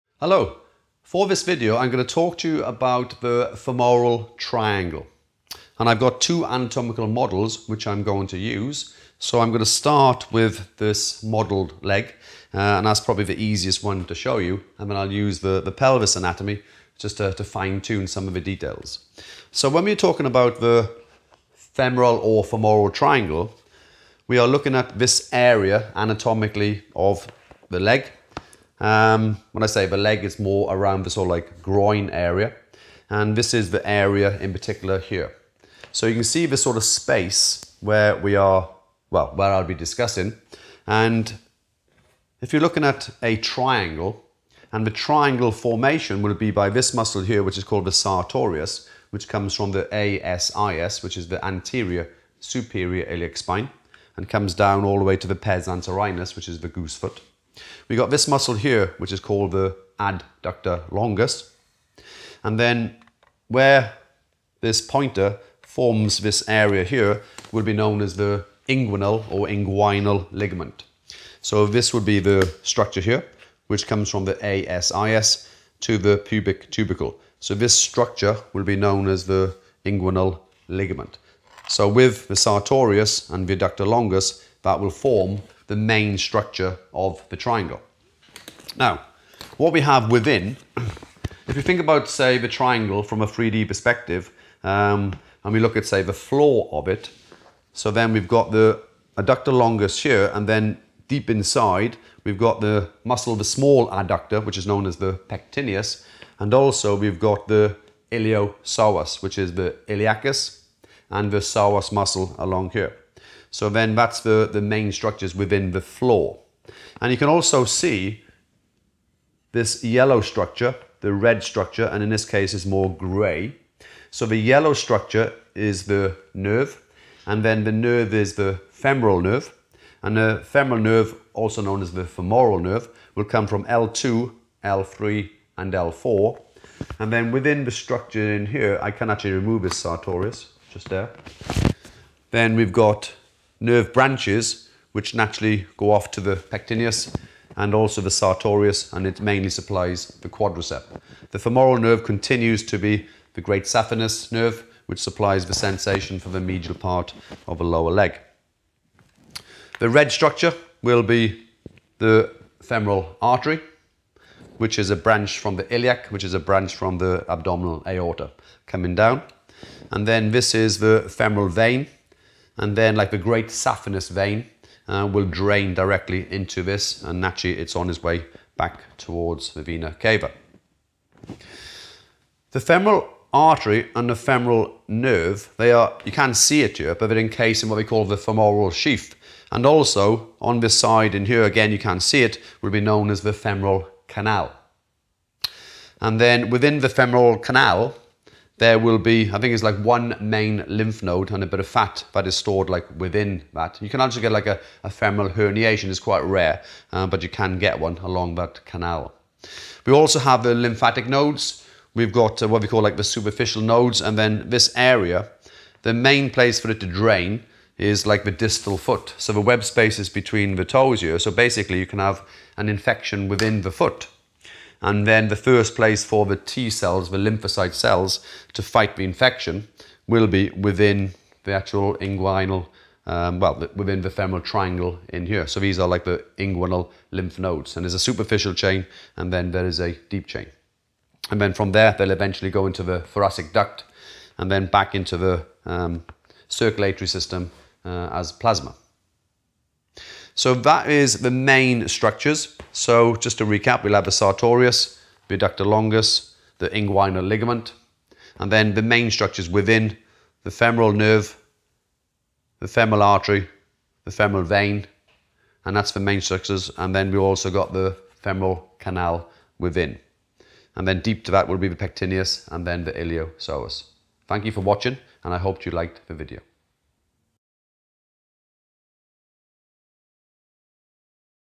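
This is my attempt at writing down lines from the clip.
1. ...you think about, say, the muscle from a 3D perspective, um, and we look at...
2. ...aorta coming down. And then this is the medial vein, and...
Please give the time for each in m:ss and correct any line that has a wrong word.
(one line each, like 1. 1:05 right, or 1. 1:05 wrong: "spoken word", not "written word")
1. 1:31 wrong: "triangle", not "muscle"
2. 2:47 wrong: "femoral", not "medial".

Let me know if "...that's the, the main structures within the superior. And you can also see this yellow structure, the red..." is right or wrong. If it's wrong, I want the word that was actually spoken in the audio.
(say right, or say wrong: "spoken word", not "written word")
wrong: "floor", not "superior".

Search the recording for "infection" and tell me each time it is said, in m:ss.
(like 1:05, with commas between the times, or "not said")
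3:42, 3:49.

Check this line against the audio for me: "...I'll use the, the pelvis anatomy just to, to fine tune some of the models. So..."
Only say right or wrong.
wrong.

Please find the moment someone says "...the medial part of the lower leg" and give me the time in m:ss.
2:36.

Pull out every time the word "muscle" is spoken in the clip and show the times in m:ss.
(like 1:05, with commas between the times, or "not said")
0:46, 0:58, 1:43, 1:51.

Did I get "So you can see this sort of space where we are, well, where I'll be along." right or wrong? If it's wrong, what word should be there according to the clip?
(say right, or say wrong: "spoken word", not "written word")
wrong: "discussing", not "along".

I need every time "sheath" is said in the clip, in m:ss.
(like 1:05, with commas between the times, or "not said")
3:08.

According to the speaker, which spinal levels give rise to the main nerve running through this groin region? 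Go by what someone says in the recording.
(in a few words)
L2, L3, and L4.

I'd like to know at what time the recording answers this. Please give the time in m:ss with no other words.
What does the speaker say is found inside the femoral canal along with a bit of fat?
3:19.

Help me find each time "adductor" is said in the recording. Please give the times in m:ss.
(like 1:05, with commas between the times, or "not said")
0:59, 1:23, 1:39, 1:43, 4:15.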